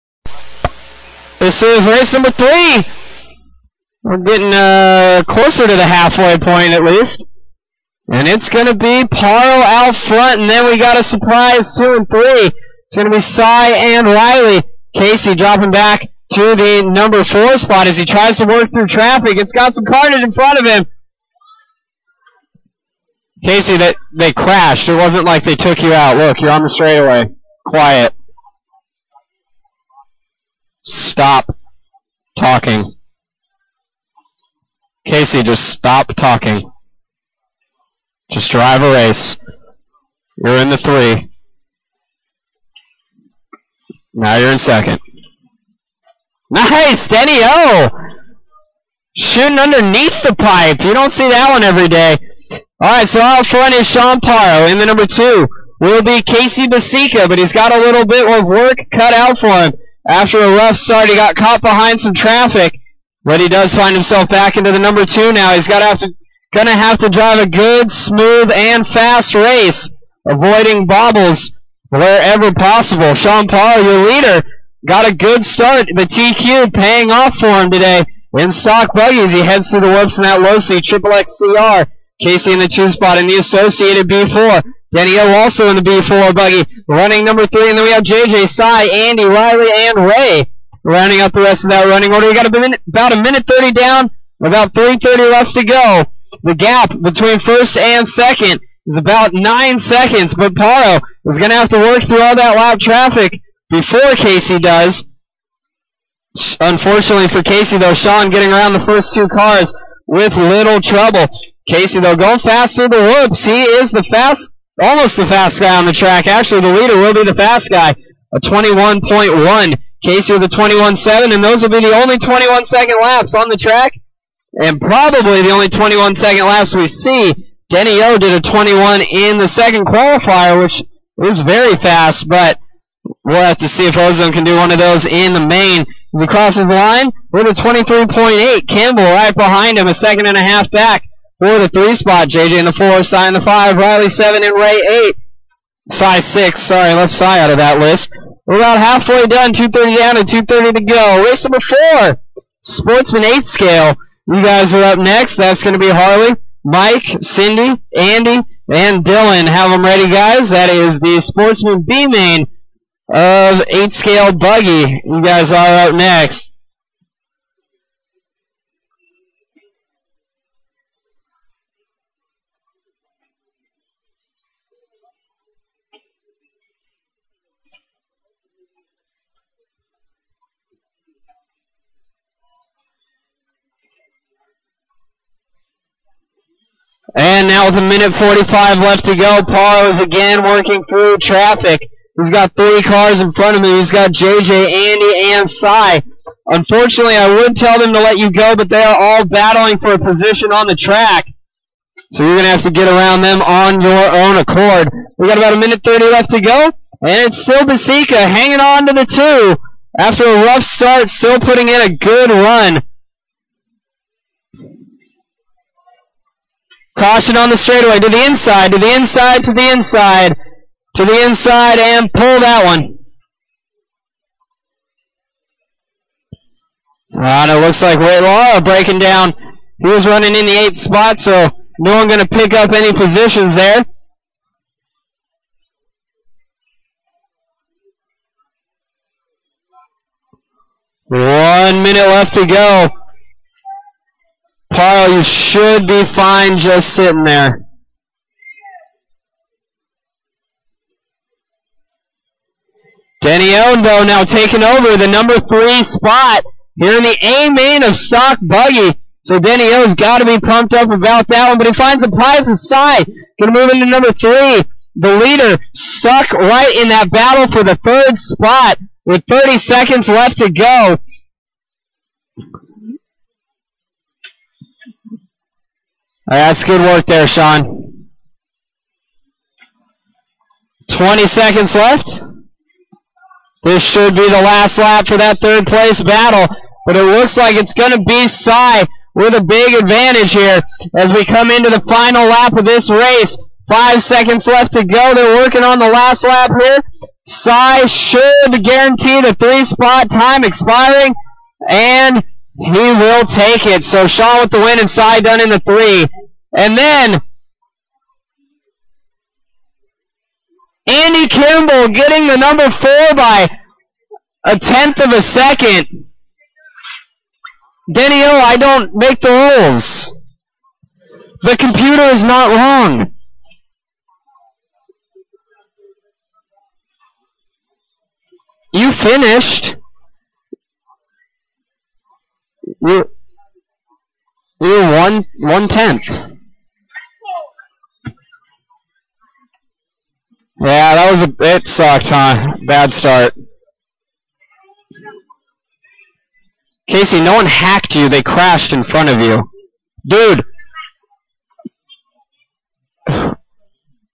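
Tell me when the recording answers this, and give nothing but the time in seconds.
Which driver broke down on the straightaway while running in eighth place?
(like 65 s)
227 s.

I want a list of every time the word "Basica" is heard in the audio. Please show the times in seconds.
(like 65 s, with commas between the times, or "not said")
56 s, 207 s.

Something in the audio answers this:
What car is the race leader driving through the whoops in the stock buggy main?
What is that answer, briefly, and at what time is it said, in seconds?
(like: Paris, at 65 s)
Losi triple XCR, at 80 s.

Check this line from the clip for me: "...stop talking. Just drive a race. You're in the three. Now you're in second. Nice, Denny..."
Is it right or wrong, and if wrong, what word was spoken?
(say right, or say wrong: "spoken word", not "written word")
right.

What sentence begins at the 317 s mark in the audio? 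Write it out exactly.
Denny O, I don't make the rules.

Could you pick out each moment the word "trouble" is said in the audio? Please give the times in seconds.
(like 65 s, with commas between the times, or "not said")
110 s.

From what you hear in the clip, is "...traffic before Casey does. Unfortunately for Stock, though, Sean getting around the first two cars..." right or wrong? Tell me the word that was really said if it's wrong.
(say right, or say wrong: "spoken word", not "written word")
wrong: "Casey", not "Stock".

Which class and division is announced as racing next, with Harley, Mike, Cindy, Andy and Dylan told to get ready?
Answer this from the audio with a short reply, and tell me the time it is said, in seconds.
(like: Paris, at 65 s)
Sportsman 8 scale, at 152 s.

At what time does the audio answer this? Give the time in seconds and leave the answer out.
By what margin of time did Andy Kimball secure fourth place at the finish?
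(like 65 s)
314 s.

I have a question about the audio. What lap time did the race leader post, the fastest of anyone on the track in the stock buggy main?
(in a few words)
21.1.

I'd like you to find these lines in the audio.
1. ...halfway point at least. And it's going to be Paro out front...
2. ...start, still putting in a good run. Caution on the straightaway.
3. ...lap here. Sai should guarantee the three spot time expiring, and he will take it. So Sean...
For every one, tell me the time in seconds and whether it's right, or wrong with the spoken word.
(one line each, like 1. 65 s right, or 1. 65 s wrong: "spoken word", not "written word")
1. 5 s right
2. 210 s right
3. 296 s right.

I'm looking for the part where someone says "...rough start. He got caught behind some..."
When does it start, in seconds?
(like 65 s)
60 s.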